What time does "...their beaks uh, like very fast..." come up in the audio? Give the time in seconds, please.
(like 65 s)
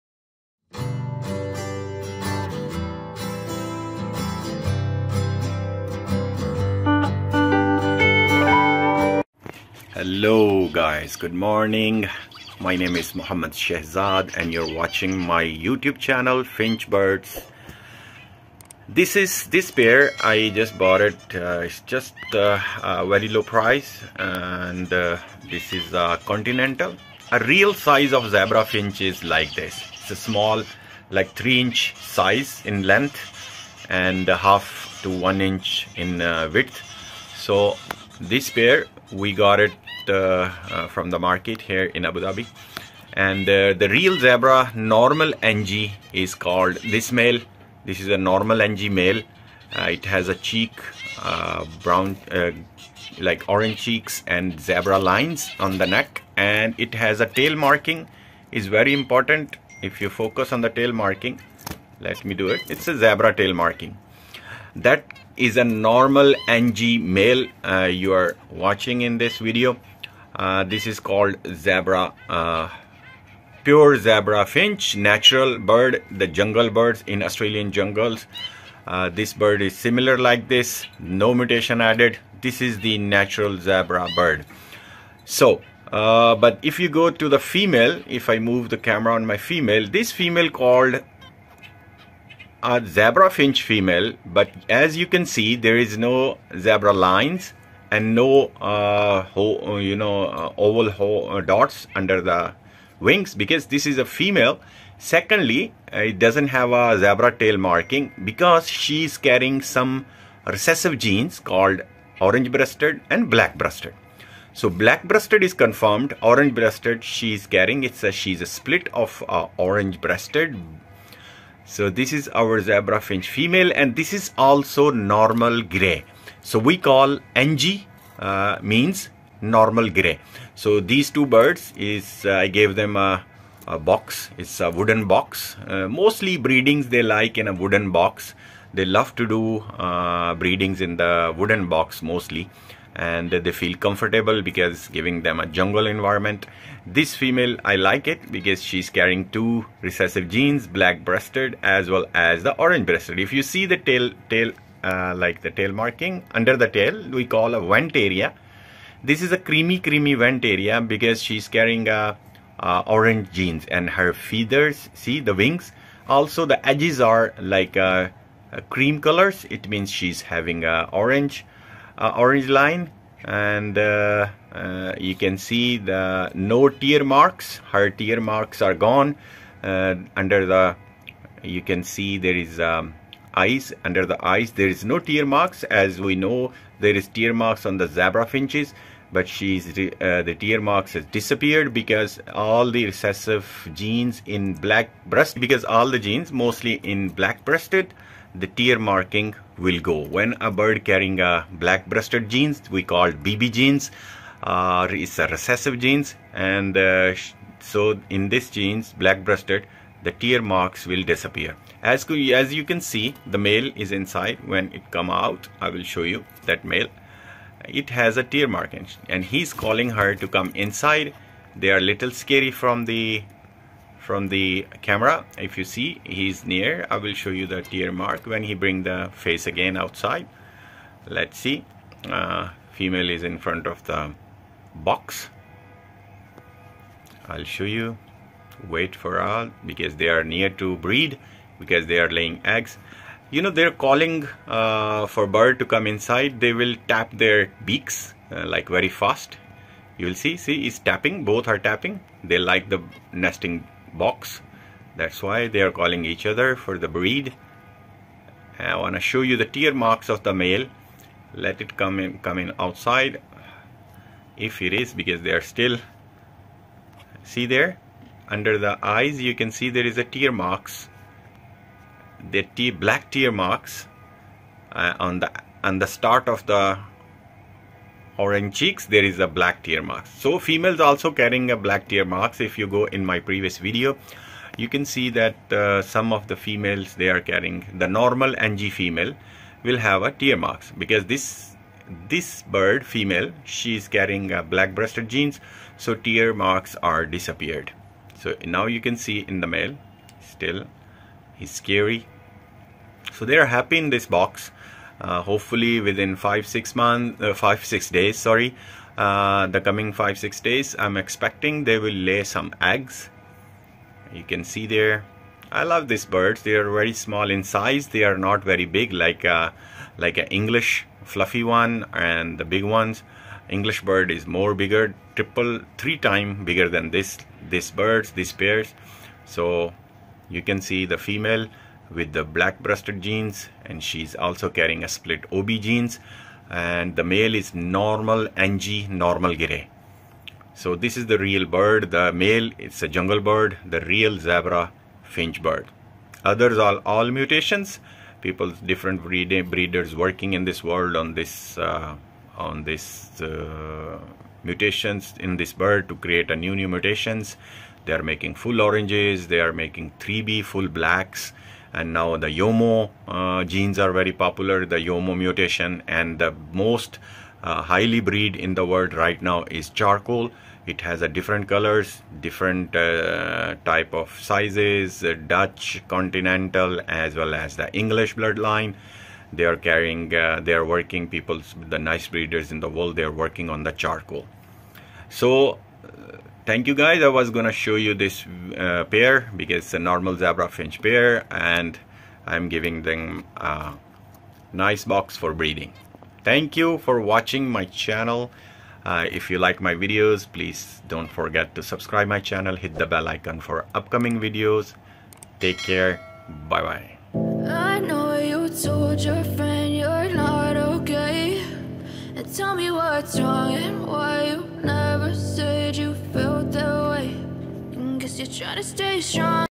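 247 s.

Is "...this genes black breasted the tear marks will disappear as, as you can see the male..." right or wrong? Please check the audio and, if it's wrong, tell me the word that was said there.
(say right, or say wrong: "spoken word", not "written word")
right.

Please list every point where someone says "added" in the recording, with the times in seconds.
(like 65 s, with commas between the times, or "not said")
81 s.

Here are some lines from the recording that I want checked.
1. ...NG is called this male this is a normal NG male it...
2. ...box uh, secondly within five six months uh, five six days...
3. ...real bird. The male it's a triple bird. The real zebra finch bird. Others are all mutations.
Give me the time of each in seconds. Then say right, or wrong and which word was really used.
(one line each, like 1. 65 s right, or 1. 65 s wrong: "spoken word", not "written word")
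1. 45 s right
2. 304 s wrong: "hopefully", not "secondly"
3. 341 s wrong: "jungle", not "triple".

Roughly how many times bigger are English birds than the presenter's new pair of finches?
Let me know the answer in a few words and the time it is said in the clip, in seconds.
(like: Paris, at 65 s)
3, at 325 s.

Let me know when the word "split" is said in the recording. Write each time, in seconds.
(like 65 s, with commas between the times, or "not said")
118 s, 334 s.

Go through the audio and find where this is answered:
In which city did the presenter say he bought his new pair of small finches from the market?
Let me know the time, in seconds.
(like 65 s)
42 s.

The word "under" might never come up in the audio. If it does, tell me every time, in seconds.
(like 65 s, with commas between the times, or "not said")
101 s, 156 s, 179 s, 183 s, 268 s.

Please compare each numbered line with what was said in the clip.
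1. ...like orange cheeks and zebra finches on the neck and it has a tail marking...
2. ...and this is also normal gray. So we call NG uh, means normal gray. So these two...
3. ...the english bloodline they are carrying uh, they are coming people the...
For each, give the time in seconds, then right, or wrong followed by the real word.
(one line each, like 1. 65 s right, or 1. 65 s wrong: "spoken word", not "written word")
1. 53 s wrong: "lines", not "finches"
2. 123 s right
3. 377 s wrong: "working", not "coming".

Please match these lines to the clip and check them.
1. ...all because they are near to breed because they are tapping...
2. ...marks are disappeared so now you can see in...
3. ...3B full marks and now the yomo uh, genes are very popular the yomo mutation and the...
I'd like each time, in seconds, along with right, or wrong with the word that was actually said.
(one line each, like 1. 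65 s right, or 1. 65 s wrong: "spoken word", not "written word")
1. 239 s wrong: "laying", not "tapping"
2. 296 s right
3. 359 s wrong: "blacks", not "marks".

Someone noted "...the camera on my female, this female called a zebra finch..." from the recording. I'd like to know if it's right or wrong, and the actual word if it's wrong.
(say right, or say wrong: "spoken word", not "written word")
right.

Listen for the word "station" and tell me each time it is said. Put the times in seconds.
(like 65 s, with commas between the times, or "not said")
not said.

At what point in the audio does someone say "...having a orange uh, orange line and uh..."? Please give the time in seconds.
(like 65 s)
170 s.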